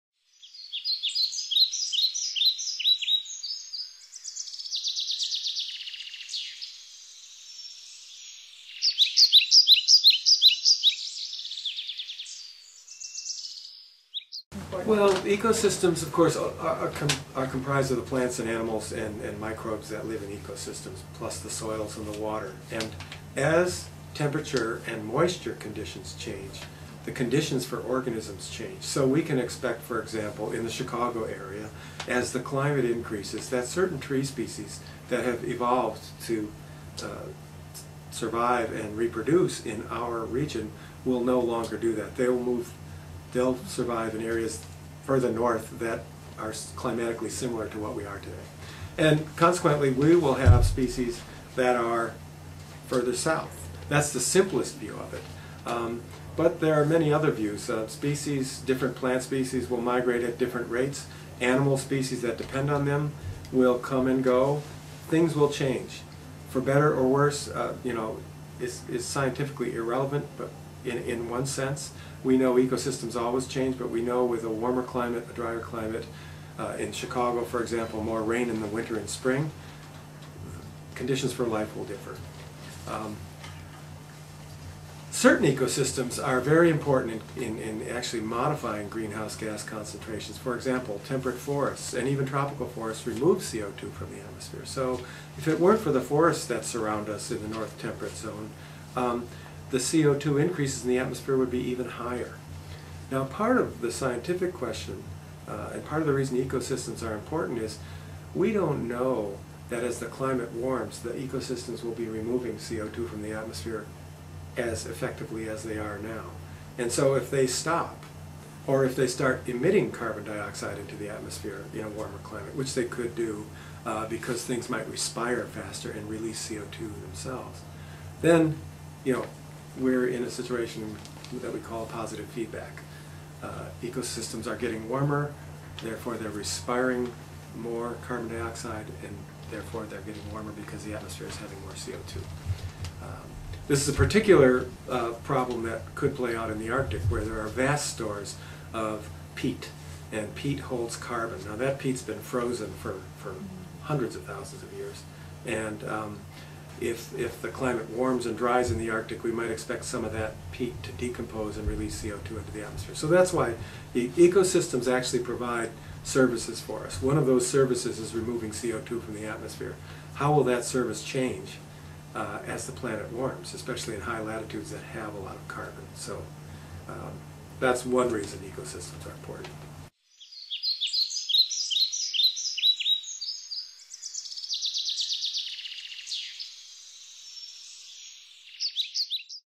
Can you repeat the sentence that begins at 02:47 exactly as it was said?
One of those services is removing CO2 from the atmosphere.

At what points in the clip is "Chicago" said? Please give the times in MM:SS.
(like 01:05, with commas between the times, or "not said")
00:30, 01:16.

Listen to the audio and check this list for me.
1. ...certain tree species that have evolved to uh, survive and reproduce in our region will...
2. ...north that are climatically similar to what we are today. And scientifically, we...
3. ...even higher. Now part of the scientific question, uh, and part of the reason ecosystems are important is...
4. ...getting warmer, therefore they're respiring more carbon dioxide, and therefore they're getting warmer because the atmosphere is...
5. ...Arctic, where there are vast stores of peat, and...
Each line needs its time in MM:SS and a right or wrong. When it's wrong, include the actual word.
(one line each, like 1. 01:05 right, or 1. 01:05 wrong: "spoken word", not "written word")
1. 00:33 right
2. 00:45 wrong: "consequently", not "scientifically"
3. 01:41 right
4. 02:14 right
5. 02:26 right.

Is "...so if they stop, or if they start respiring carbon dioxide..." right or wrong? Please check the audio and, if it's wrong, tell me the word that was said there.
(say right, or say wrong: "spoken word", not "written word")
wrong: "emitting", not "respiring".